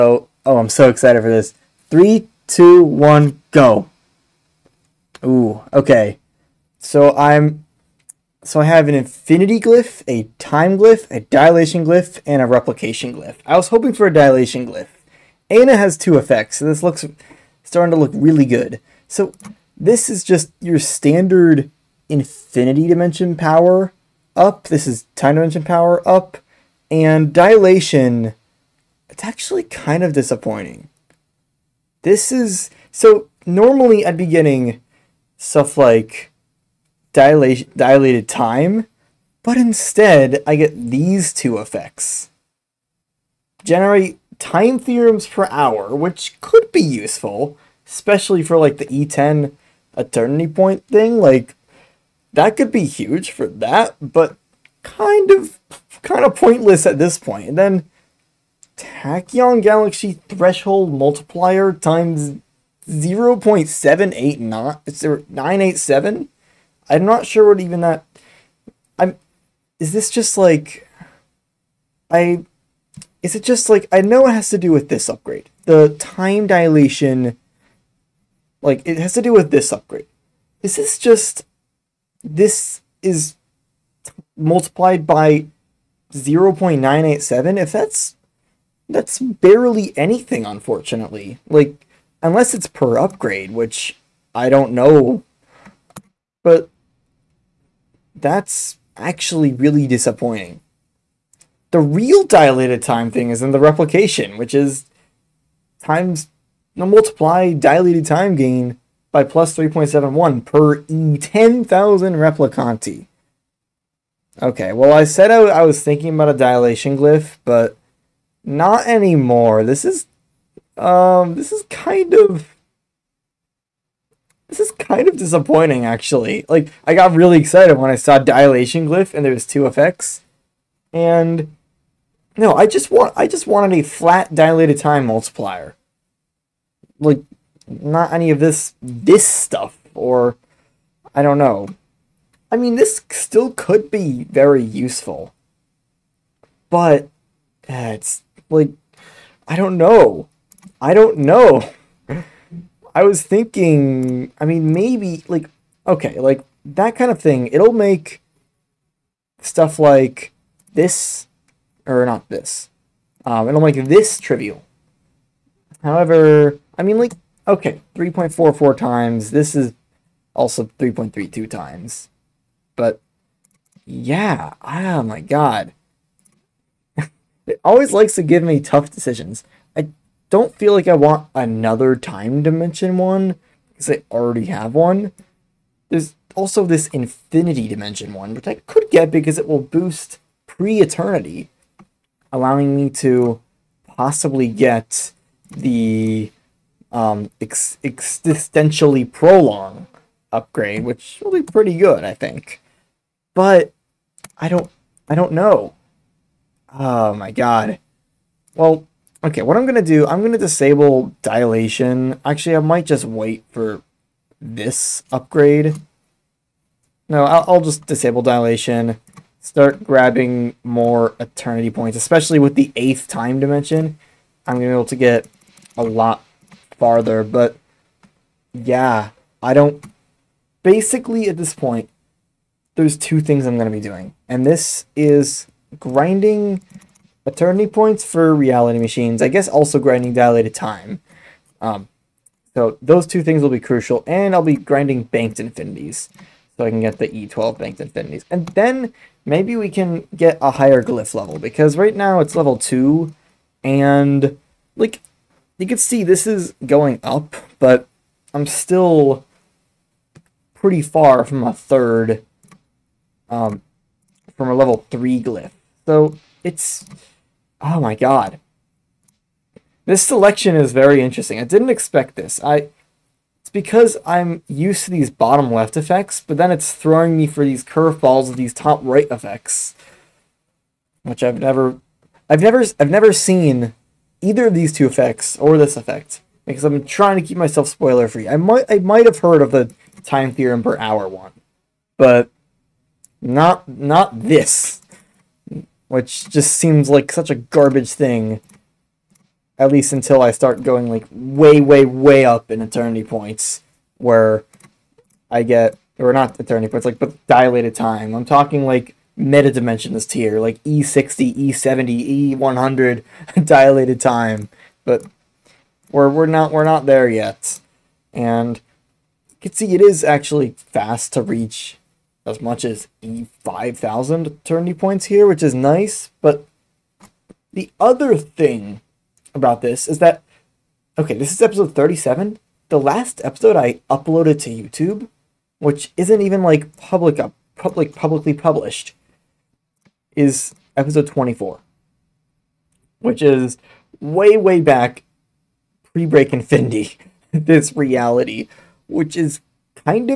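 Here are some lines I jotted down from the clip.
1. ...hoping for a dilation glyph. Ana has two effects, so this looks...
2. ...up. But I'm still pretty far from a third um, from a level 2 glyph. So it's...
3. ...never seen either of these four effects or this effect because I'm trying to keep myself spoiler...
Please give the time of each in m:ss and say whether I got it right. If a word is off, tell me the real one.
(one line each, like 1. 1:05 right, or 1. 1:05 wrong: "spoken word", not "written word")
1. 0:13 right
2. 4:17 wrong: "3", not "2"
3. 4:42 wrong: "two", not "four".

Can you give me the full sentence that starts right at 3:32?
Actually, I might just wait for this upgrade.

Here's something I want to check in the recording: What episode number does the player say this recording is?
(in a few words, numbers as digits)
37.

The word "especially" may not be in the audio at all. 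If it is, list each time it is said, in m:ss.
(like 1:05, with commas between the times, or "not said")
0:47, 3:41.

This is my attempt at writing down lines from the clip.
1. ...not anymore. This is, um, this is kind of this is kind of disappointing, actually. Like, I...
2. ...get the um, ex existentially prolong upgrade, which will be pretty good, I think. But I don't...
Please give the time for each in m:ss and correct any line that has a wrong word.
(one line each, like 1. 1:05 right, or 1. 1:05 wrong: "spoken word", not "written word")
1. 1:58 right
2. 3:14 right.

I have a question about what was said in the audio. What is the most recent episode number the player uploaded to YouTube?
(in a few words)
24.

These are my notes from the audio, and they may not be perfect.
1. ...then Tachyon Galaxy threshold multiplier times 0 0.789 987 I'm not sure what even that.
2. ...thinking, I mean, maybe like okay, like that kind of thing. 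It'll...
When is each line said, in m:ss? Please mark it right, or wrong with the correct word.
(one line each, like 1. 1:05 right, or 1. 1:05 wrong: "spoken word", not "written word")
1. 0:57 right
2. 2:33 right.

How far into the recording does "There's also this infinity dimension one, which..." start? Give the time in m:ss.
3:05.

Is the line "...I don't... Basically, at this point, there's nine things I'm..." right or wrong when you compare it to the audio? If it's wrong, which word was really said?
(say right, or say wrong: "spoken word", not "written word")
wrong: "two", not "nine".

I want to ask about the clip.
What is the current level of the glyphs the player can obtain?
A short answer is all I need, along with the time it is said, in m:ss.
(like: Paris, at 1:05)
2, at 4:12.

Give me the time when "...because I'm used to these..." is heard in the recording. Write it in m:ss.
4:33.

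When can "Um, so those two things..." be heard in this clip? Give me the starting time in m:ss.
4:01.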